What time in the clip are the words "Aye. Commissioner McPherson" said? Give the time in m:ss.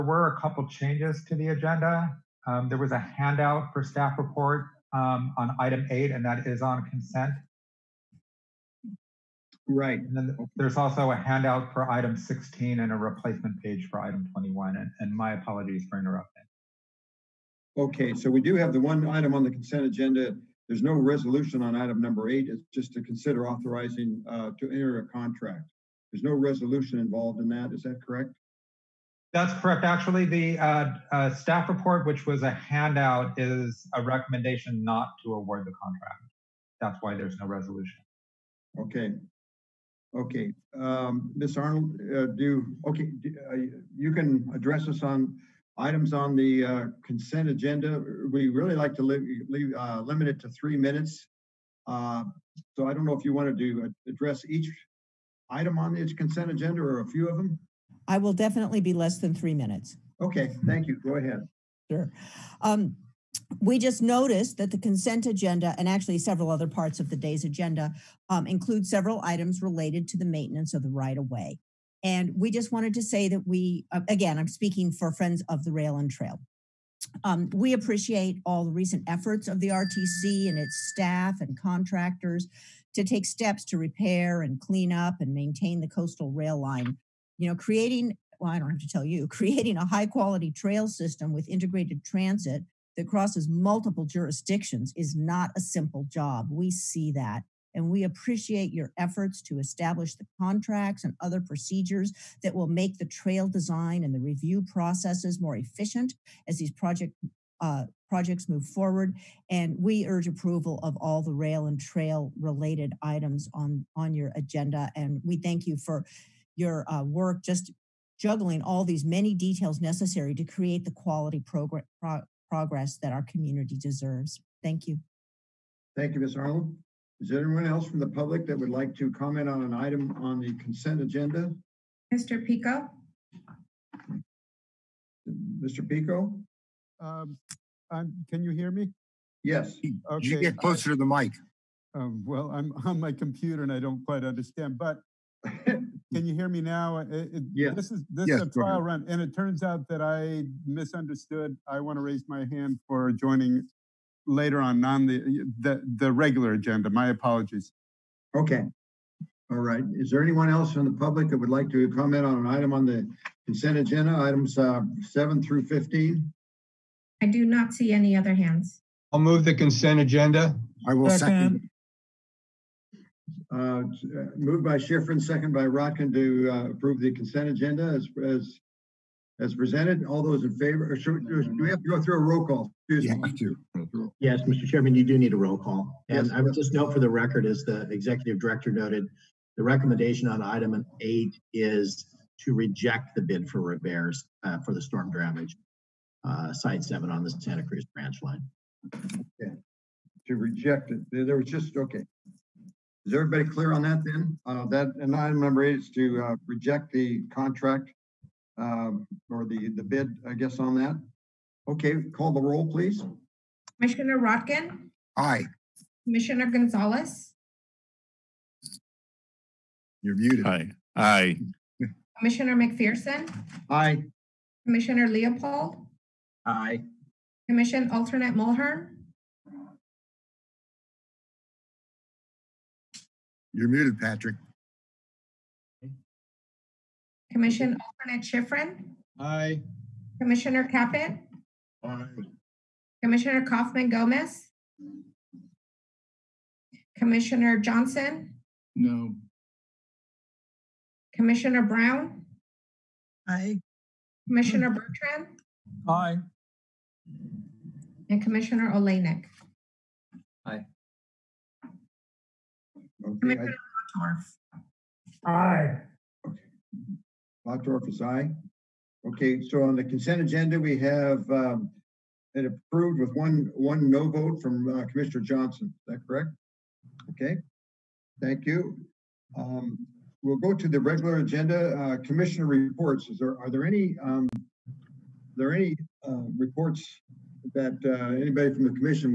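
3:40.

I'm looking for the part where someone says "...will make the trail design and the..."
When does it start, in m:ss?
1:42.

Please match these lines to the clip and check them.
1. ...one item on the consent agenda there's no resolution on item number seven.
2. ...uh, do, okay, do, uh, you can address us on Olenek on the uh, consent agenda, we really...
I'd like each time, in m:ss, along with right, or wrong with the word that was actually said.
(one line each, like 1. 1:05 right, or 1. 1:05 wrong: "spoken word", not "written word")
1. 0:18 wrong: "eight", not "seven"
2. 0:42 wrong: "Items", not "Olenek".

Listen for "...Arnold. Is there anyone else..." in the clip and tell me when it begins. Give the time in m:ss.
2:06.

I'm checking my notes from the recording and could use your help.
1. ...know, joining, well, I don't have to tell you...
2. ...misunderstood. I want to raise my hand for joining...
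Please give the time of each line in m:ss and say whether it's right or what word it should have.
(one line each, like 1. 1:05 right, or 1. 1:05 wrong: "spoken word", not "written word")
1. 1:27 wrong: "creating", not "joining"
2. 2:30 right.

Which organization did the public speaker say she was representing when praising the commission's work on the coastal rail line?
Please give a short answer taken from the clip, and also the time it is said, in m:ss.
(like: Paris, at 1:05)
Friends of the Rail and Trail, at 1:15.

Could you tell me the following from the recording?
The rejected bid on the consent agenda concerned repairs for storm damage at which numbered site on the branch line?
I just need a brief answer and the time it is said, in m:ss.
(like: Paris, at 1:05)
site 7, at 3:16.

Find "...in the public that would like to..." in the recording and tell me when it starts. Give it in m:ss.
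2:40.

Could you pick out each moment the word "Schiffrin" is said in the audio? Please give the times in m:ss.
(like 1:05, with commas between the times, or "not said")
2:54, 3:58.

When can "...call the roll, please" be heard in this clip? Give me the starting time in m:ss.
3:32.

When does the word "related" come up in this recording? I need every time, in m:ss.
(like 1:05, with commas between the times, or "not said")
1:09, 1:52.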